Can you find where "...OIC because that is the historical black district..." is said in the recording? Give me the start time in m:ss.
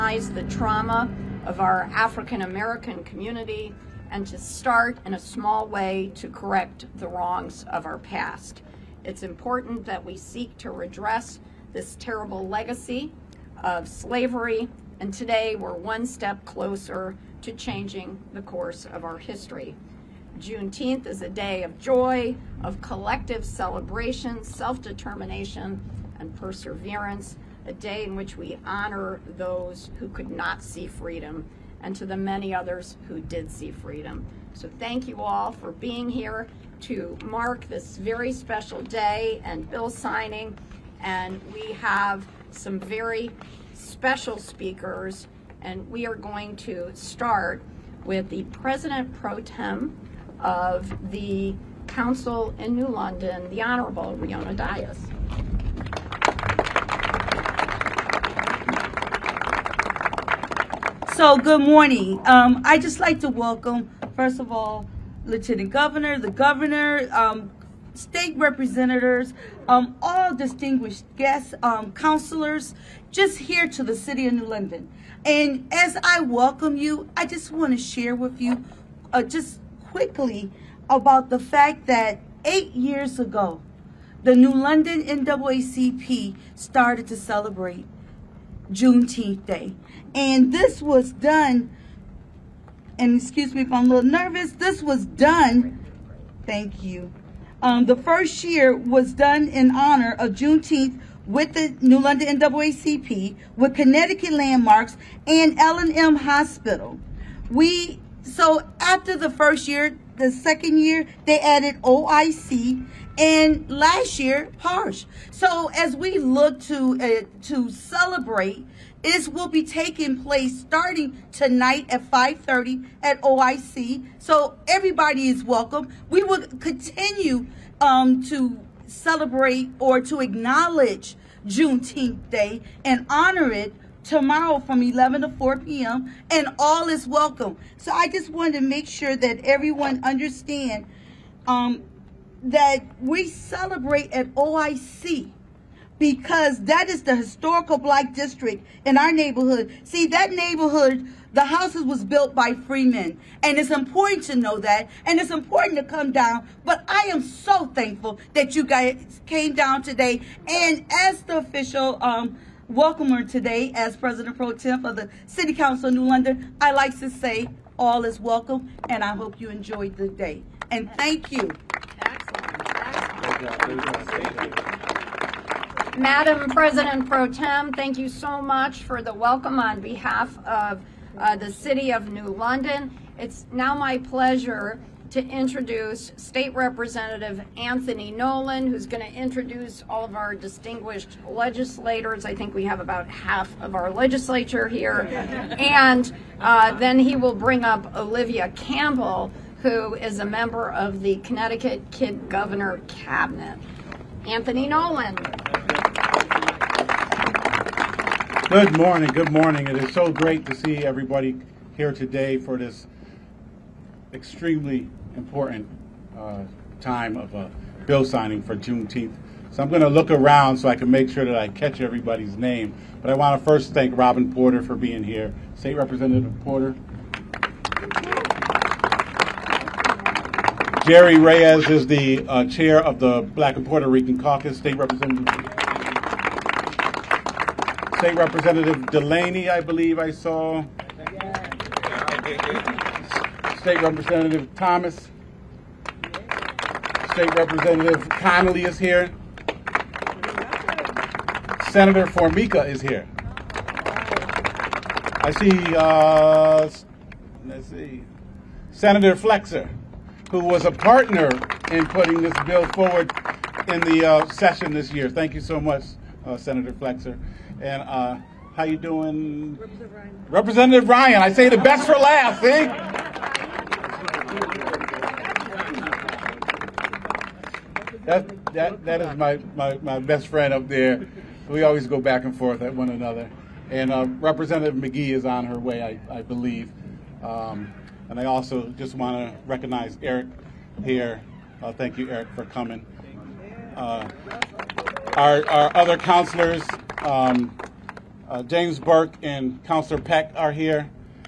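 2:24.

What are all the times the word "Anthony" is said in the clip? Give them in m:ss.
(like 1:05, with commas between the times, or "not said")
3:07, 3:24.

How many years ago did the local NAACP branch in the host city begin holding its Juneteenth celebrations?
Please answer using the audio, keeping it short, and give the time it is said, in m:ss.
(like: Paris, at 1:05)
8, at 1:22.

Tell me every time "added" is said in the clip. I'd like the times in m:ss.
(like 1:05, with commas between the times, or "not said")
1:51.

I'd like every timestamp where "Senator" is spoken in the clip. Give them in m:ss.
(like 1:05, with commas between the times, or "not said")
4:11, 4:18, 4:26.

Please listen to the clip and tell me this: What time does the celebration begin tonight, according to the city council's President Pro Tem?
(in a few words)
5:30.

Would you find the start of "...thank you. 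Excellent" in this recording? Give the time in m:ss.
2:50.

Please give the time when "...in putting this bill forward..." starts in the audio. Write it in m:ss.
4:21.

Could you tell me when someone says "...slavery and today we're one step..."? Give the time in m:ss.
0:13.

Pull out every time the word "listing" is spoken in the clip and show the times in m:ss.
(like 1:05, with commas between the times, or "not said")
not said.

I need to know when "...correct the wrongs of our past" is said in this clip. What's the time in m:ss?
0:06.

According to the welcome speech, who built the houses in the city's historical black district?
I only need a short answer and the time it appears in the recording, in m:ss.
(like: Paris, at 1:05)
freemen, at 2:32.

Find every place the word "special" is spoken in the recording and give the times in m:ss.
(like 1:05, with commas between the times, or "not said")
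0:38, 0:43.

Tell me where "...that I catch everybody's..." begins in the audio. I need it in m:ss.
3:41.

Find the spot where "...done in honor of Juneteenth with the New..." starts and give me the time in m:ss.
1:39.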